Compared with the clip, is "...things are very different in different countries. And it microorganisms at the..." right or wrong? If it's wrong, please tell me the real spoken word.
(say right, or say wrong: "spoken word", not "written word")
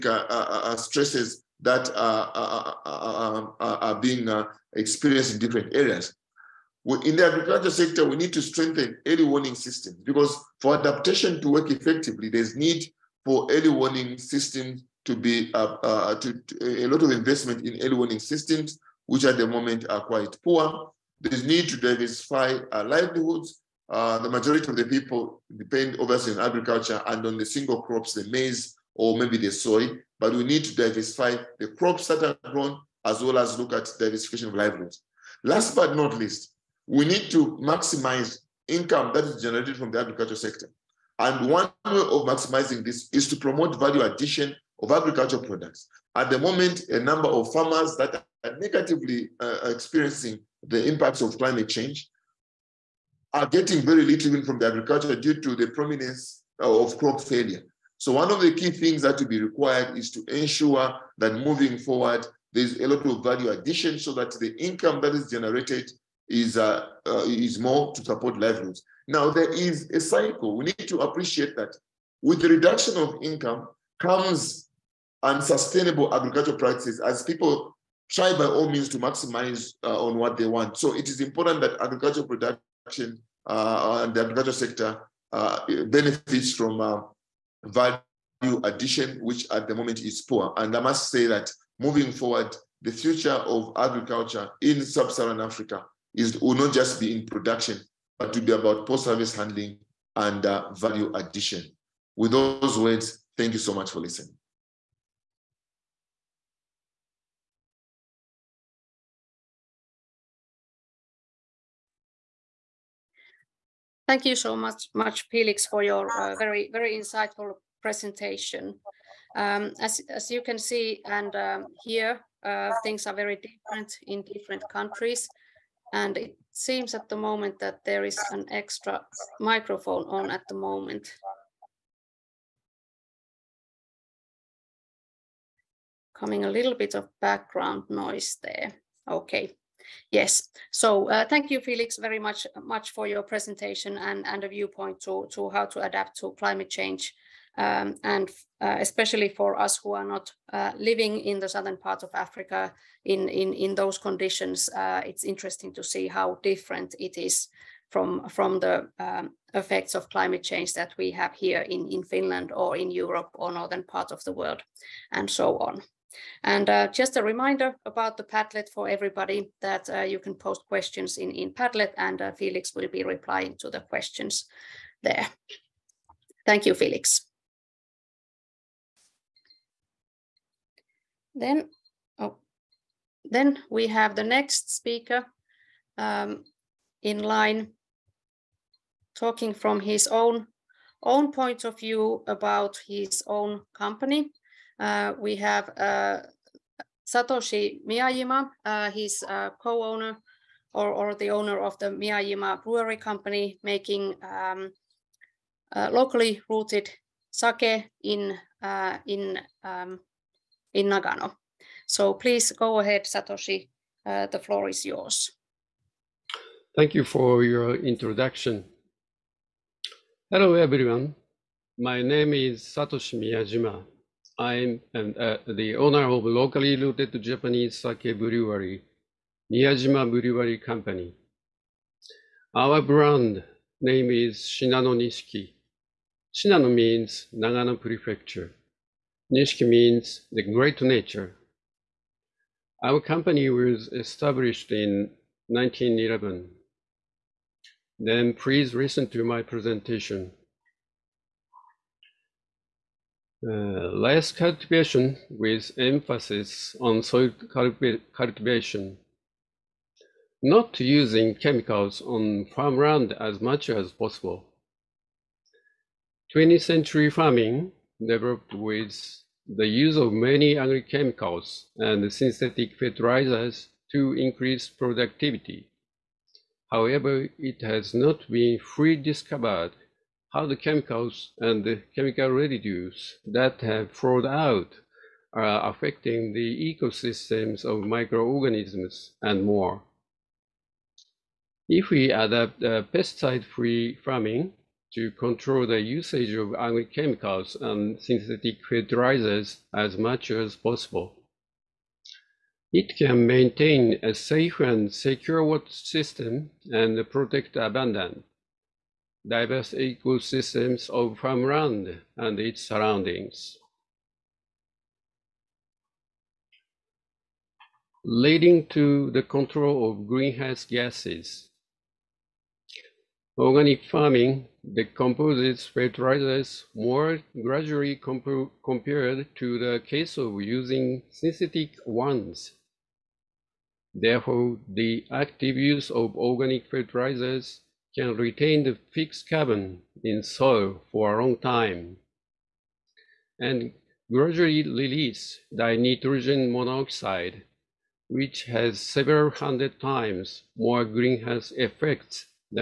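wrong: "seems", not "microorganisms".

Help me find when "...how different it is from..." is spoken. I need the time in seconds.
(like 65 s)
156 s.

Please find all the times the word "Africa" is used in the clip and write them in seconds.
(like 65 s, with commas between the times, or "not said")
95 s, 152 s.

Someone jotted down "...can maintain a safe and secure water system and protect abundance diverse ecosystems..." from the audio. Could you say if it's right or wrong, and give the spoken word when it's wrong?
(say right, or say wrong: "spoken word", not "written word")
right.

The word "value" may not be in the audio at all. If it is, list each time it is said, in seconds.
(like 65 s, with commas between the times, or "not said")
43 s, 63 s, 87 s, 100 s.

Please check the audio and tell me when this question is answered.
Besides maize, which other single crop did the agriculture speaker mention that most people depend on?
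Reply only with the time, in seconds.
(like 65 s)
29 s.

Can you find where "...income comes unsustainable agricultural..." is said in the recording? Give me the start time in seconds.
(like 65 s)
73 s.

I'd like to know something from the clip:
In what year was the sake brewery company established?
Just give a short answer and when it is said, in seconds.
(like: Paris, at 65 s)
1911, at 245 s.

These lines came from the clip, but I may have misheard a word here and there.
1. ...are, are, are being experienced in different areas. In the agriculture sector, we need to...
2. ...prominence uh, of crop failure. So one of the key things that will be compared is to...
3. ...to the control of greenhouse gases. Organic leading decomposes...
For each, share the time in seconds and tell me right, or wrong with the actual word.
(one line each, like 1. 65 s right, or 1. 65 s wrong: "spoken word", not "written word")
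1. 1 s right
2. 55 s wrong: "required", not "compared"
3. 318 s wrong: "farming", not "leading".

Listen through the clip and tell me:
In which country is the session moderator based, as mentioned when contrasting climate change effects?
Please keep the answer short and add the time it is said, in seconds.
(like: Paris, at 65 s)
Finland, at 162 s.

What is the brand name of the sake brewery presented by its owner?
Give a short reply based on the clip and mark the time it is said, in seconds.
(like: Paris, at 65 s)
Shinano Nishiki, at 234 s.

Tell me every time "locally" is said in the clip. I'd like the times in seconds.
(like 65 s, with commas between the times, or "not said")
205 s, 226 s.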